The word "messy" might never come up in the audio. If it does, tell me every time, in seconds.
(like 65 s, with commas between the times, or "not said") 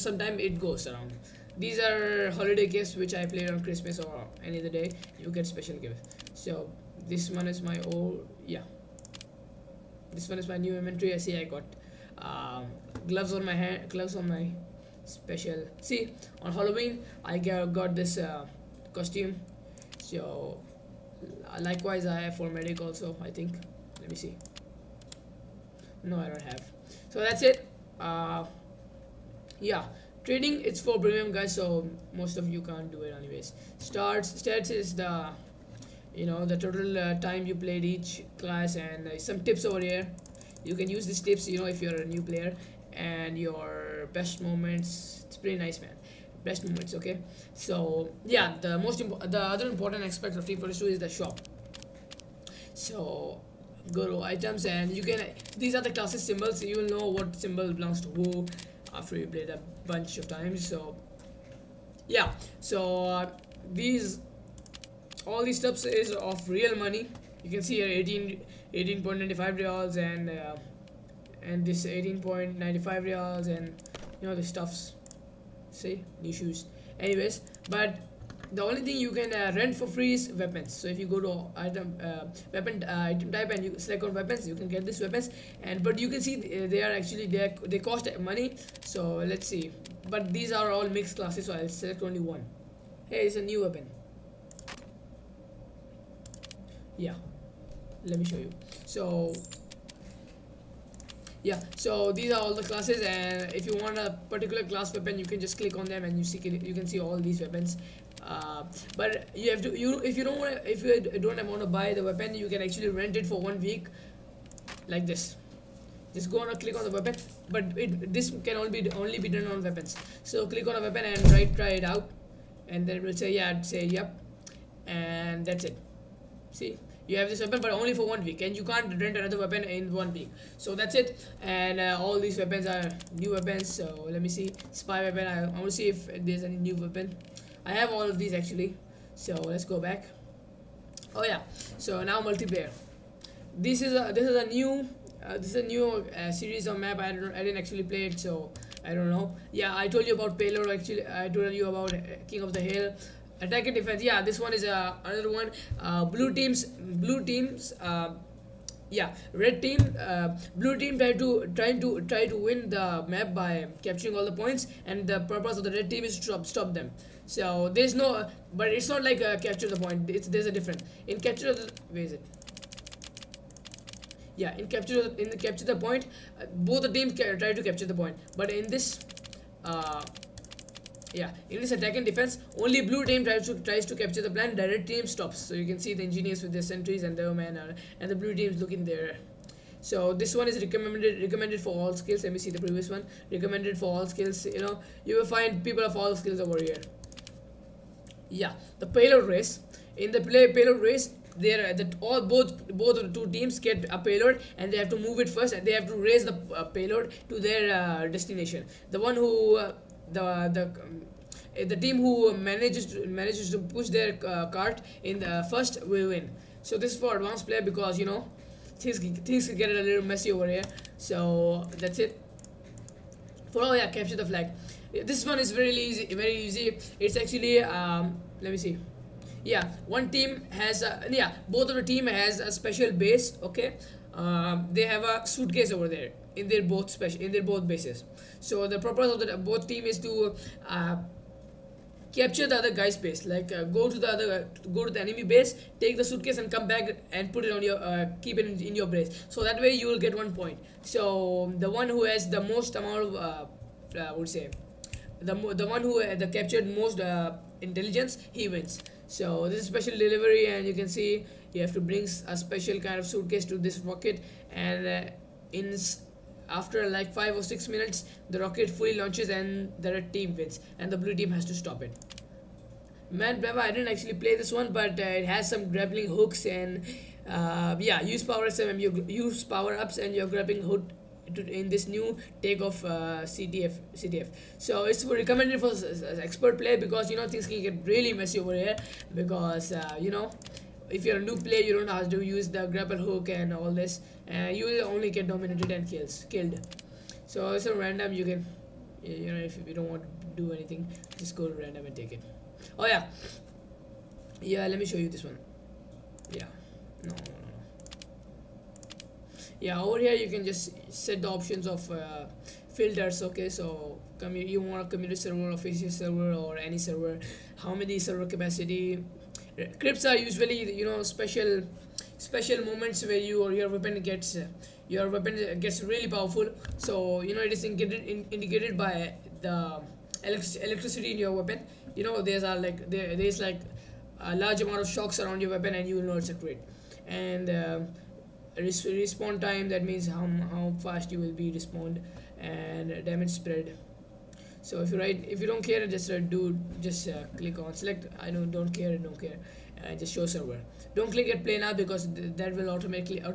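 220 s, 288 s.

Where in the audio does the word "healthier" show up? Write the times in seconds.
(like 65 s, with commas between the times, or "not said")
not said.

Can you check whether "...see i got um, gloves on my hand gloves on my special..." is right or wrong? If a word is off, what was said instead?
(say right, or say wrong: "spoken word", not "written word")
right.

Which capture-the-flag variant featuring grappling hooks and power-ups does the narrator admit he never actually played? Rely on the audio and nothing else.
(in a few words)
Mannpower.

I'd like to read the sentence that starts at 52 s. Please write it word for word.
So, go to items and you can, these are the classes symbols.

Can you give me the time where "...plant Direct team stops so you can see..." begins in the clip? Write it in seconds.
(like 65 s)
184 s.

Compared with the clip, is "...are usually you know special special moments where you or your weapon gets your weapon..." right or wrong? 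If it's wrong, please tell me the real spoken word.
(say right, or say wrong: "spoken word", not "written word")
right.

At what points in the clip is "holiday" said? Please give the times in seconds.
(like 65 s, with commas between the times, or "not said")
2 s.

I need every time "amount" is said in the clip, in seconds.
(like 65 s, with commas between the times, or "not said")
252 s, 334 s.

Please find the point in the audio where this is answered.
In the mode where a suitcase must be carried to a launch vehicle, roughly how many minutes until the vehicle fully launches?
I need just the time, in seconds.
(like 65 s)
267 s.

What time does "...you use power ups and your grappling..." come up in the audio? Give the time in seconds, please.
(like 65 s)
278 s.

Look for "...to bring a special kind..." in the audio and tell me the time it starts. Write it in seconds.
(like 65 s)
261 s.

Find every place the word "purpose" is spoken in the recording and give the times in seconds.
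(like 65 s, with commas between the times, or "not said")
165 s, 238 s.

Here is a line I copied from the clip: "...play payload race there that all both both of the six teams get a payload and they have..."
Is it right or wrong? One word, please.
wrong.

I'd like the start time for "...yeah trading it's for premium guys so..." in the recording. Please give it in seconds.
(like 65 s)
29 s.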